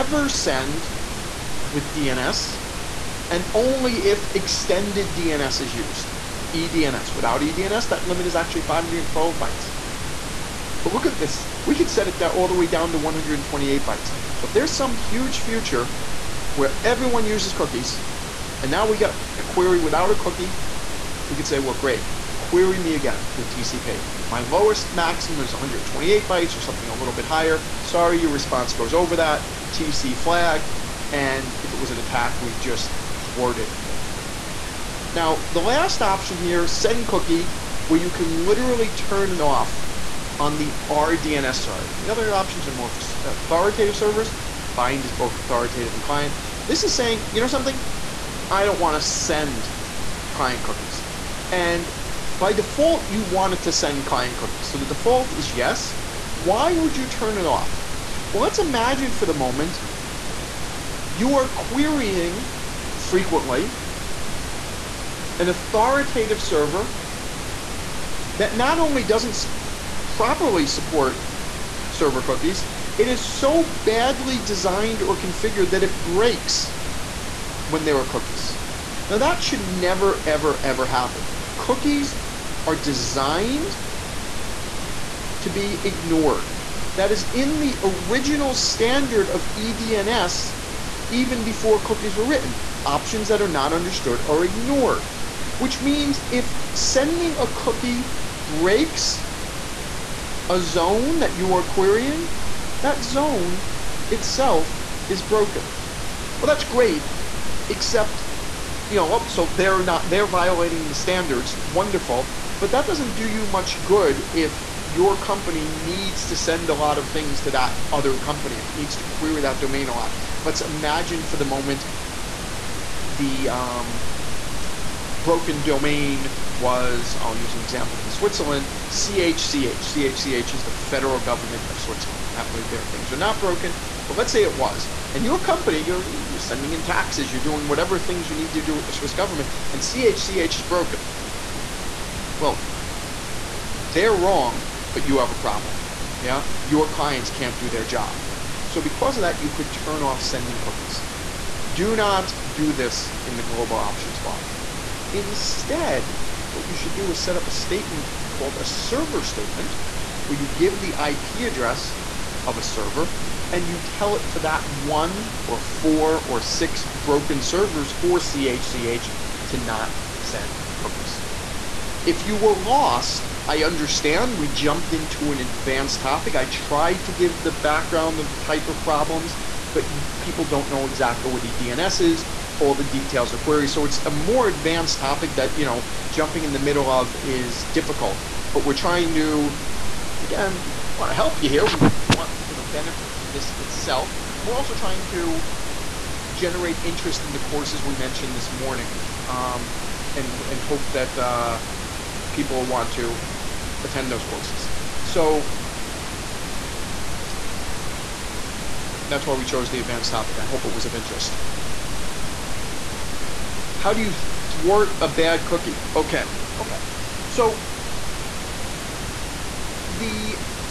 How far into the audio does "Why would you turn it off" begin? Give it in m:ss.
0:56.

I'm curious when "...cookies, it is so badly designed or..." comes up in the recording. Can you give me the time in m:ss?
1:12.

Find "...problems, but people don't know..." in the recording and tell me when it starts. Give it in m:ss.
2:58.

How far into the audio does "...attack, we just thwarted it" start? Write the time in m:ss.
0:31.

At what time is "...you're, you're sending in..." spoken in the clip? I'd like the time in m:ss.
2:15.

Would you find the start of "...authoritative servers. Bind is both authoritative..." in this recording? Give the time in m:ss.
0:43.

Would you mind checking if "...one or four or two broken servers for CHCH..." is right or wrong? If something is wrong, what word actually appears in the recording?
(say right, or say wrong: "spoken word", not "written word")
wrong: "six", not "two".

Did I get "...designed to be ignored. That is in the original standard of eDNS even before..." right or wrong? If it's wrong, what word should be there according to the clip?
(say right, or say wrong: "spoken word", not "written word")
right.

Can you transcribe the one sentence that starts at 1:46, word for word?
Well, that's great, except you know, oh, so they're not they're violating the standards.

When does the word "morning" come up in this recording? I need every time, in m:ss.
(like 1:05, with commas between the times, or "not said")
3:18.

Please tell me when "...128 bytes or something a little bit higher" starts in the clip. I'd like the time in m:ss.
0:25.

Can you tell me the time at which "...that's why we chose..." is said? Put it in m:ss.
3:29.